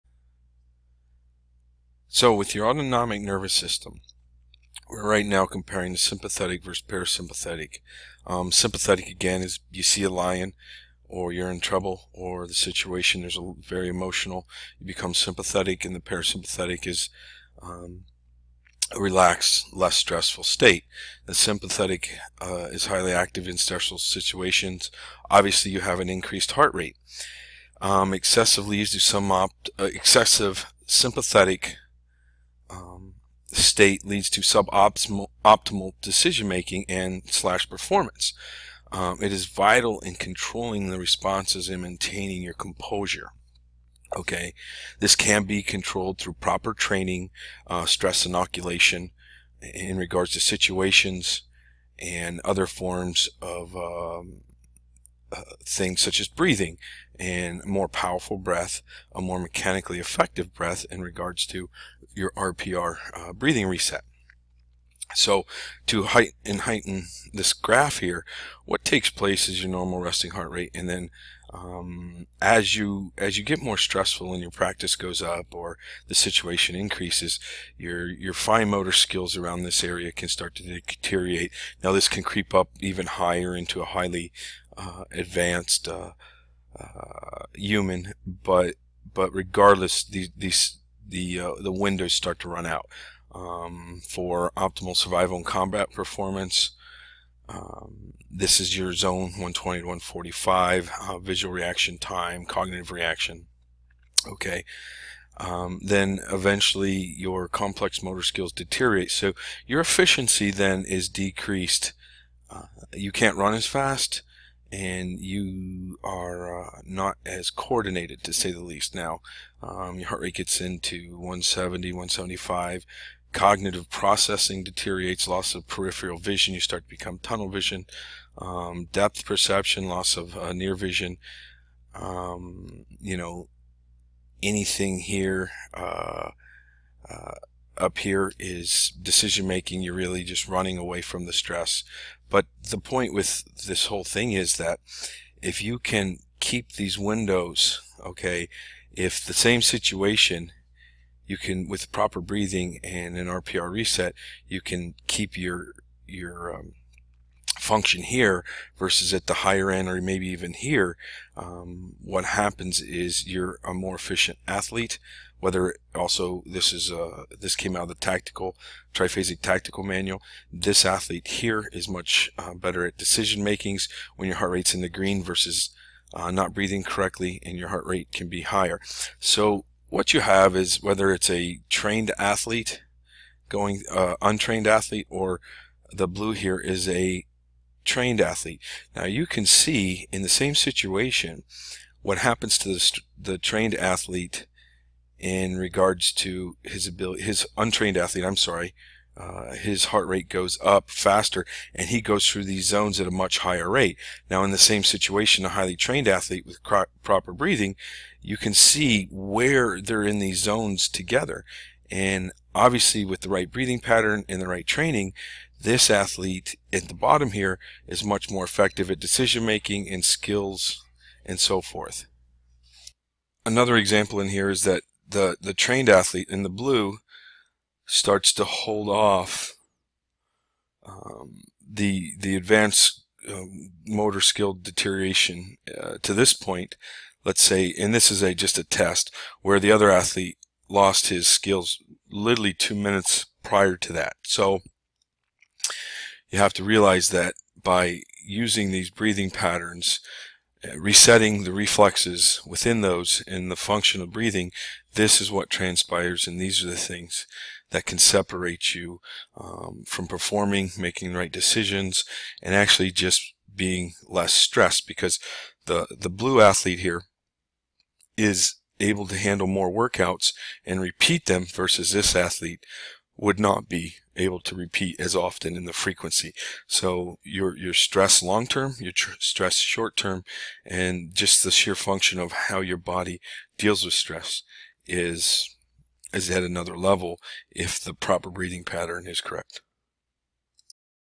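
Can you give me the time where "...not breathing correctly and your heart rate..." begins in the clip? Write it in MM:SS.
02:56.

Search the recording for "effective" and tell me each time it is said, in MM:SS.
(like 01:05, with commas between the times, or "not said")
00:59, 03:38.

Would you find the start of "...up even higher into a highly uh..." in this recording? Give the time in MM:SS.
01:22.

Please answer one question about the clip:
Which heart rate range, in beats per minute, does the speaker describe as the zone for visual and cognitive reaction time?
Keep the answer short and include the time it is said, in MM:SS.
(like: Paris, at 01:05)
120 to 145, at 01:39.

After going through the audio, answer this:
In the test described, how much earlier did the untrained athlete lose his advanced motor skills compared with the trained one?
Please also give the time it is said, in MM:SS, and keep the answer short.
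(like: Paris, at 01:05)
2 minutes, at 04:02.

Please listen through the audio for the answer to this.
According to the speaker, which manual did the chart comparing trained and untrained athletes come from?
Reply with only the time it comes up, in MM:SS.
02:47.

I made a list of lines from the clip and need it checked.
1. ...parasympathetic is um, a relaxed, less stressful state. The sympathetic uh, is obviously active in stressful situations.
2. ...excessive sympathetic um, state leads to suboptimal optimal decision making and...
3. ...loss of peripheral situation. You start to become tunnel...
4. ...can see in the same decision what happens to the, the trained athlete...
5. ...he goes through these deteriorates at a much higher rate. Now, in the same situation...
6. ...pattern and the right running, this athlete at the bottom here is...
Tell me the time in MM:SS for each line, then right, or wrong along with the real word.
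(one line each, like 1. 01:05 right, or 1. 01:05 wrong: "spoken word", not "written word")
1. 00:15 wrong: "highly", not "obviously"
2. 00:29 right
3. 02:05 wrong: "vision", not "situation"
4. 03:09 wrong: "situation", not "decision"
5. 03:21 wrong: "zones", not "deteriorates"
6. 03:33 wrong: "training", not "running".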